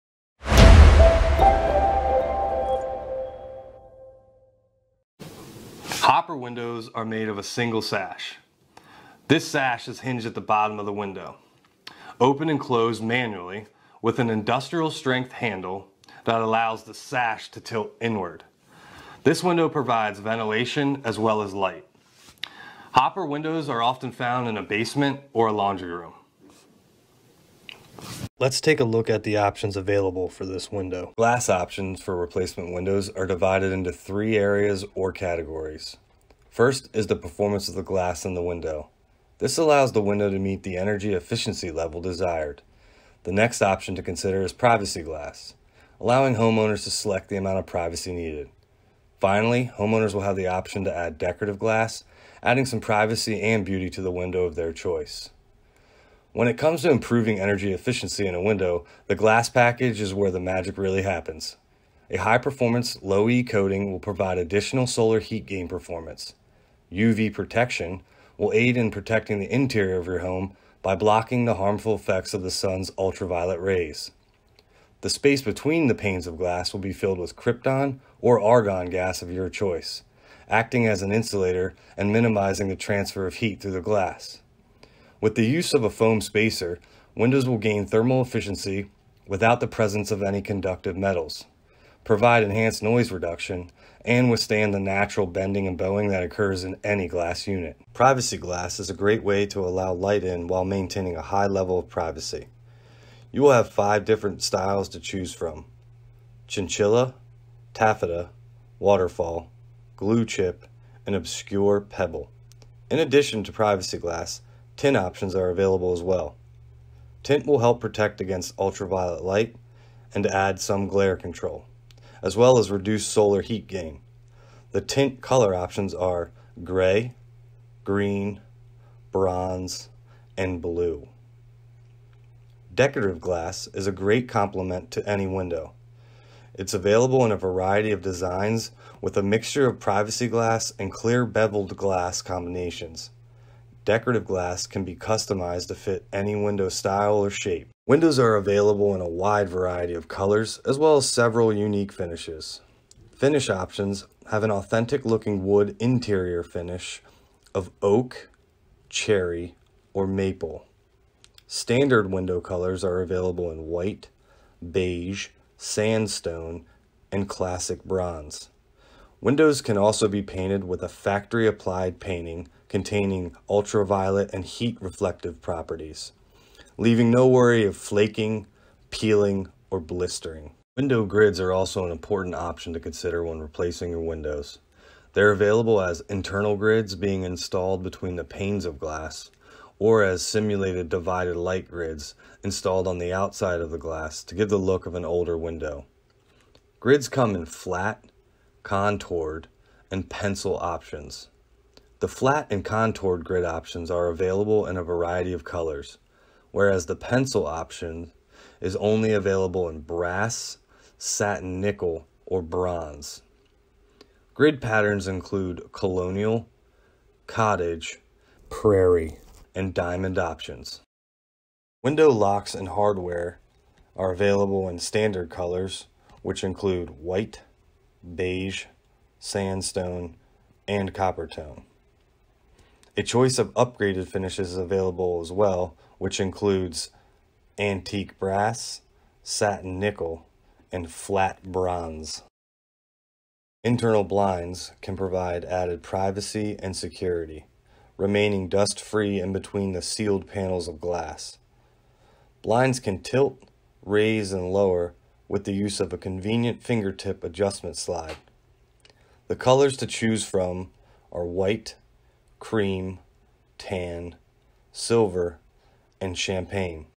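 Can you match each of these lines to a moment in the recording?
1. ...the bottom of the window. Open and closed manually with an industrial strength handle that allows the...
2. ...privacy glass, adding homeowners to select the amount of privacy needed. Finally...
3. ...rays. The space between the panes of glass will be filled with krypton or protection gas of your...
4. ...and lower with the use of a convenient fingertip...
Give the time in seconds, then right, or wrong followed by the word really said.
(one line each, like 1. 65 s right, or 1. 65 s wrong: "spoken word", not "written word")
1. 10 s right
2. 44 s wrong: "allowing", not "adding"
3. 73 s wrong: "argon", not "protection"
4. 254 s right.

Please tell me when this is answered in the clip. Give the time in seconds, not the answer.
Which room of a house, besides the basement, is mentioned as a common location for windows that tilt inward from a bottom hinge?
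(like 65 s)
25 s.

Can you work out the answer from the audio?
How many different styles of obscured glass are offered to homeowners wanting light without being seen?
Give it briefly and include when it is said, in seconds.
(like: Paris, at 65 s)
5, at 103 s.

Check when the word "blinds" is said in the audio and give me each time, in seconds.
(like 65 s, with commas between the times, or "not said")
244 s, 252 s.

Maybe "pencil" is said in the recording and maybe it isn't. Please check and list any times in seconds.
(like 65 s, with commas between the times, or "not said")
200 s, 206 s.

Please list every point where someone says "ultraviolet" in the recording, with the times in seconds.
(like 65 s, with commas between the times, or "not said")
72 s, 118 s, 173 s.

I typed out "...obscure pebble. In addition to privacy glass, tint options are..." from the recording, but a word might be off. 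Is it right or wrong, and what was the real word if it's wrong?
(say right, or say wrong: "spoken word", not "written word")
right.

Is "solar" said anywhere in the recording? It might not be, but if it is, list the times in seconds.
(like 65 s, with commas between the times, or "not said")
64 s, 123 s.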